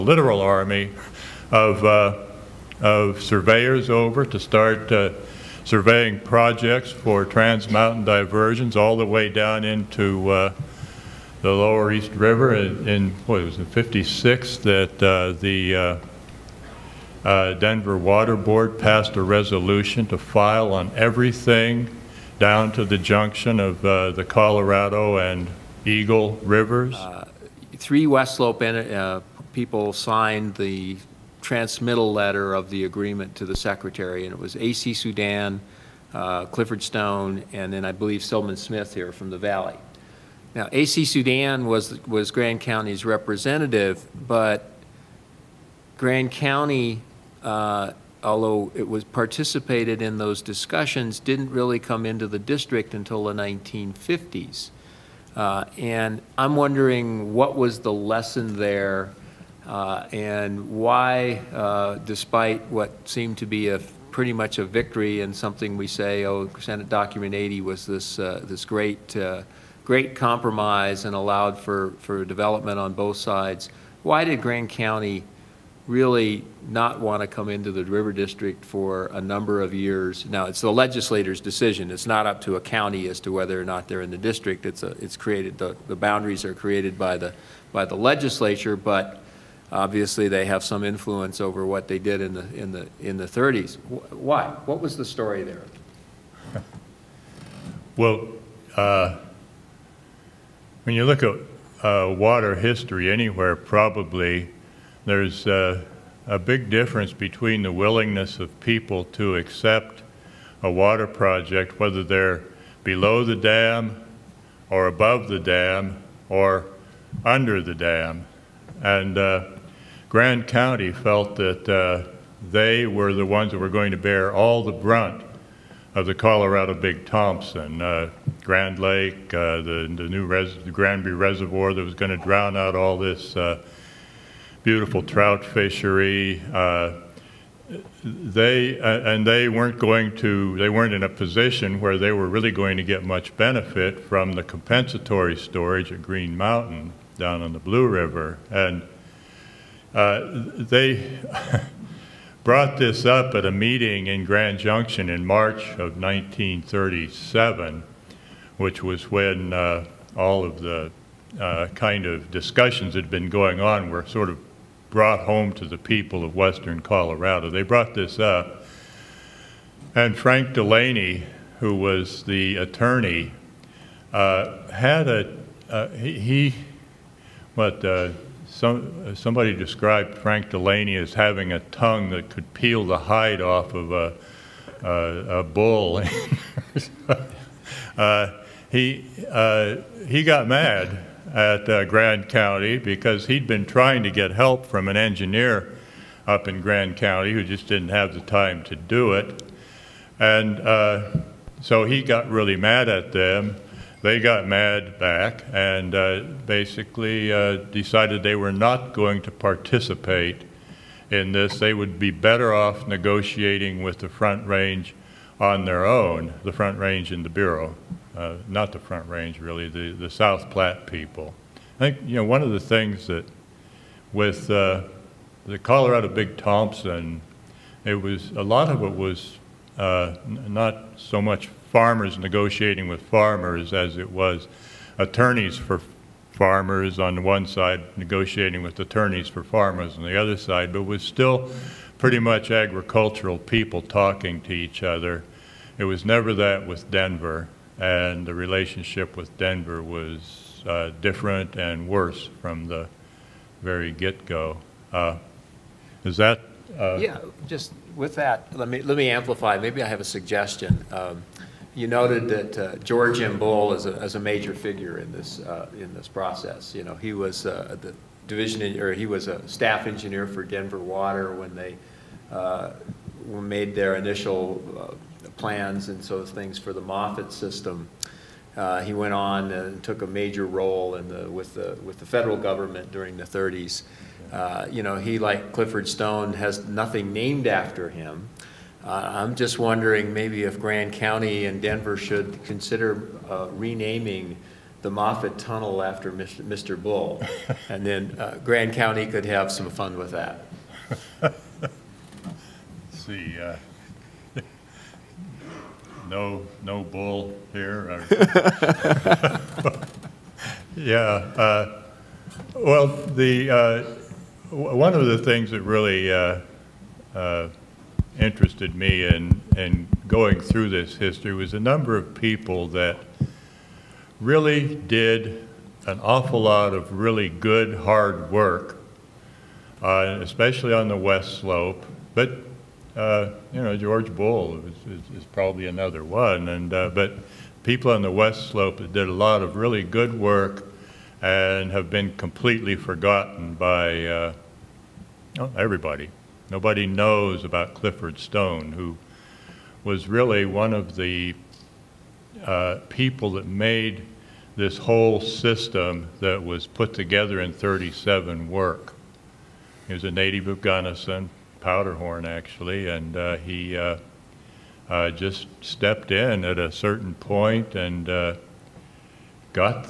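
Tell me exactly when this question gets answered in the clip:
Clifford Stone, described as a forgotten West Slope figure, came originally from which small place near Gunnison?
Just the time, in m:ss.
6:01.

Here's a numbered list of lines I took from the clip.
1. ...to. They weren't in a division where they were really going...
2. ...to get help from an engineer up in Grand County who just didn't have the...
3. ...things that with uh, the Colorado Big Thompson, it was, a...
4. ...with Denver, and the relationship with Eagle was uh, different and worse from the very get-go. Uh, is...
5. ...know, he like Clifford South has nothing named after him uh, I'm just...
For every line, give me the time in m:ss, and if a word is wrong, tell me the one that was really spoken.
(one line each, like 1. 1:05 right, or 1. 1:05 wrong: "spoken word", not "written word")
1. 2:20 wrong: "position", not "division"
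2. 3:14 right
3. 3:42 right
4. 4:06 wrong: "Denver", not "Eagle"
5. 4:44 wrong: "Stone", not "South".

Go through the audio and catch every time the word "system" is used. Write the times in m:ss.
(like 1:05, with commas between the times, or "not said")
4:37, 5:55.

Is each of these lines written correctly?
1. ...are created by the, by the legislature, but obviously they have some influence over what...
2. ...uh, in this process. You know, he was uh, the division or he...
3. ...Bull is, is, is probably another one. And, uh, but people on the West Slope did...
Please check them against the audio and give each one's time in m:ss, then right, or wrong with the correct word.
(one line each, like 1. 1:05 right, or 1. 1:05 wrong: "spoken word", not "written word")
1. 1:26 right
2. 4:25 right
3. 5:34 right.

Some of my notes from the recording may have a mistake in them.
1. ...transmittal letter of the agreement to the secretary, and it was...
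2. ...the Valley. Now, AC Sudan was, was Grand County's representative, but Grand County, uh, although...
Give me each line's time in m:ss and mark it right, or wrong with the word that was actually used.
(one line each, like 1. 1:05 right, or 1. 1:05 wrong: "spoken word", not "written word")
1. 0:31 right
2. 0:39 right.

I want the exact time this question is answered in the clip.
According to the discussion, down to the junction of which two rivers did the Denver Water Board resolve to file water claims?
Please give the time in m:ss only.
0:24.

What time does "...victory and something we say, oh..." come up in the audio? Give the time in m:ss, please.
1:04.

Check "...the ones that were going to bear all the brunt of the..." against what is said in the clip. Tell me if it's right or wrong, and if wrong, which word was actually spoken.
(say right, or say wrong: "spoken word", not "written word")
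right.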